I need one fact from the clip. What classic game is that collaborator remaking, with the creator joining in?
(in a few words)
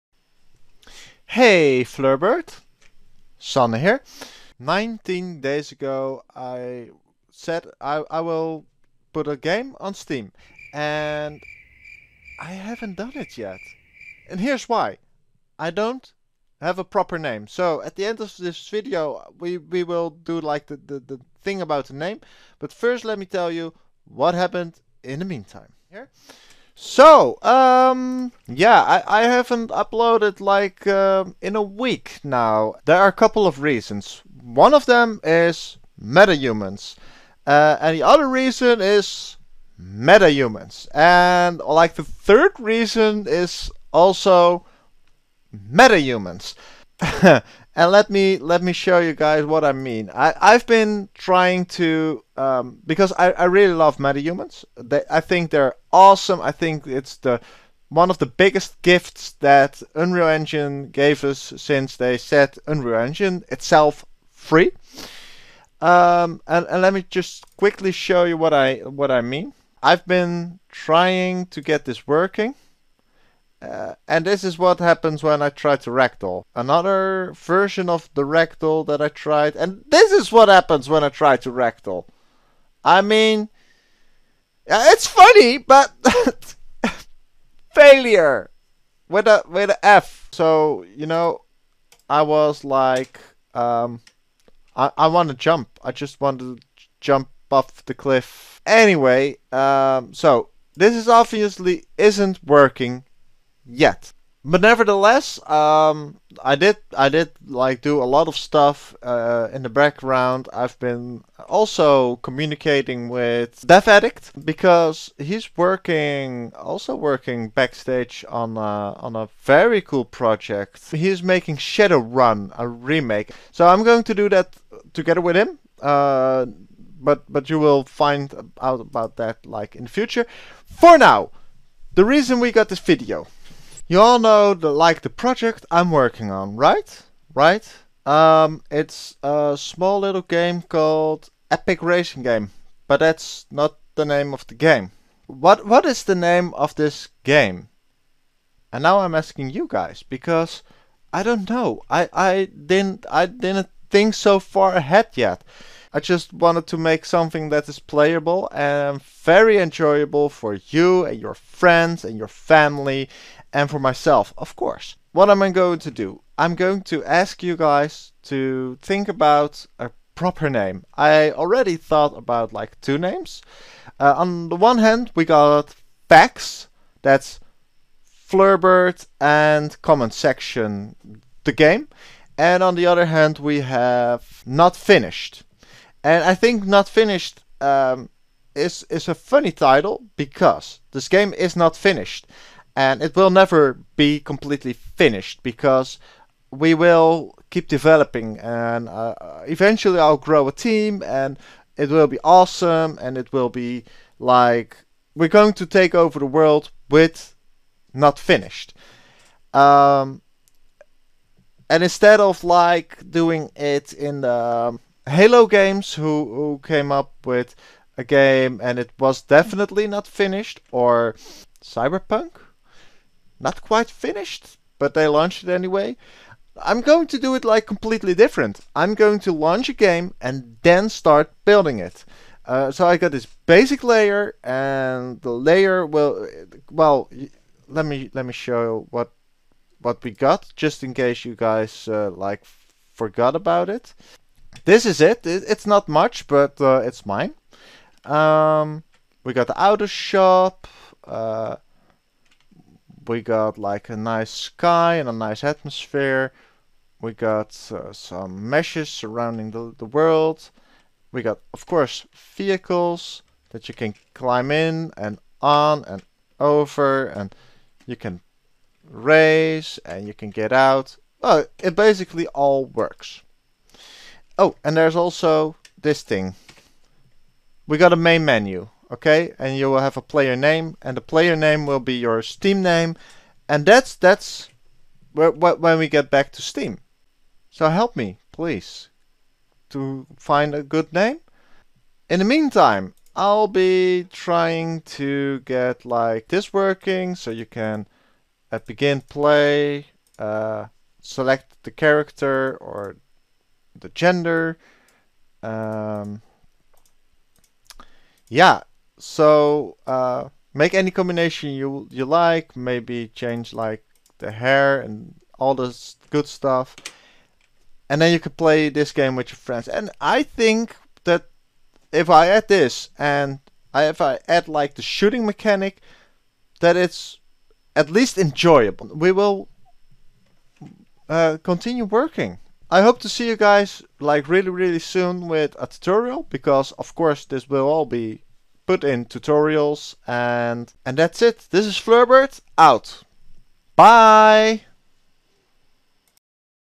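Shadowrun.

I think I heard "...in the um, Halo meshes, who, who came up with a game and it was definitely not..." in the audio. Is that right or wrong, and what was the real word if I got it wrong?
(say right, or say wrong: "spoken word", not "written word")
wrong: "games", not "meshes".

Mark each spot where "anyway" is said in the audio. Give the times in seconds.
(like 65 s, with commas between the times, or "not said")
98 s, 225 s.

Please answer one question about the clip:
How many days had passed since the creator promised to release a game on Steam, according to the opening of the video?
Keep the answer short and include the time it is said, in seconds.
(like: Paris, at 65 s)
19, at 4 s.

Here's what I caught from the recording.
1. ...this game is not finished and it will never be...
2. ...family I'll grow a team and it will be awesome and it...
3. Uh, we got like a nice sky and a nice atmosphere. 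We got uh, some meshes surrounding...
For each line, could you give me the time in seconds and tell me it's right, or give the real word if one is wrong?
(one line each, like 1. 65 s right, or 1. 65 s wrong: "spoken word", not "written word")
1. 190 s right
2. 199 s wrong: "eventually", not "family"
3. 251 s right.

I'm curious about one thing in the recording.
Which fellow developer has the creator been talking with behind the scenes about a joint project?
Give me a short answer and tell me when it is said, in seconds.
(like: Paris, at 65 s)
DevAddict, at 113 s.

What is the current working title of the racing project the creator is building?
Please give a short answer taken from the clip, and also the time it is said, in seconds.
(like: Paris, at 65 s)
Epic Racing Game, at 141 s.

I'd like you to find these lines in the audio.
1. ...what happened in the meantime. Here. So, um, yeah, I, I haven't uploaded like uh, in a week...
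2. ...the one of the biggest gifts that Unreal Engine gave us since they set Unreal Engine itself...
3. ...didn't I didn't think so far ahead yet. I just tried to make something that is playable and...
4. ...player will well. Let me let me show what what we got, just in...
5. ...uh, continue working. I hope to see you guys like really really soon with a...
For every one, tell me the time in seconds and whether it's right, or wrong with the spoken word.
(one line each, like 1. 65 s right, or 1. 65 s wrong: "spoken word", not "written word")
1. 24 s right
2. 57 s right
3. 152 s wrong: "wanted", not "tried"
4. 235 s wrong: "layer", not "player"
5. 331 s right.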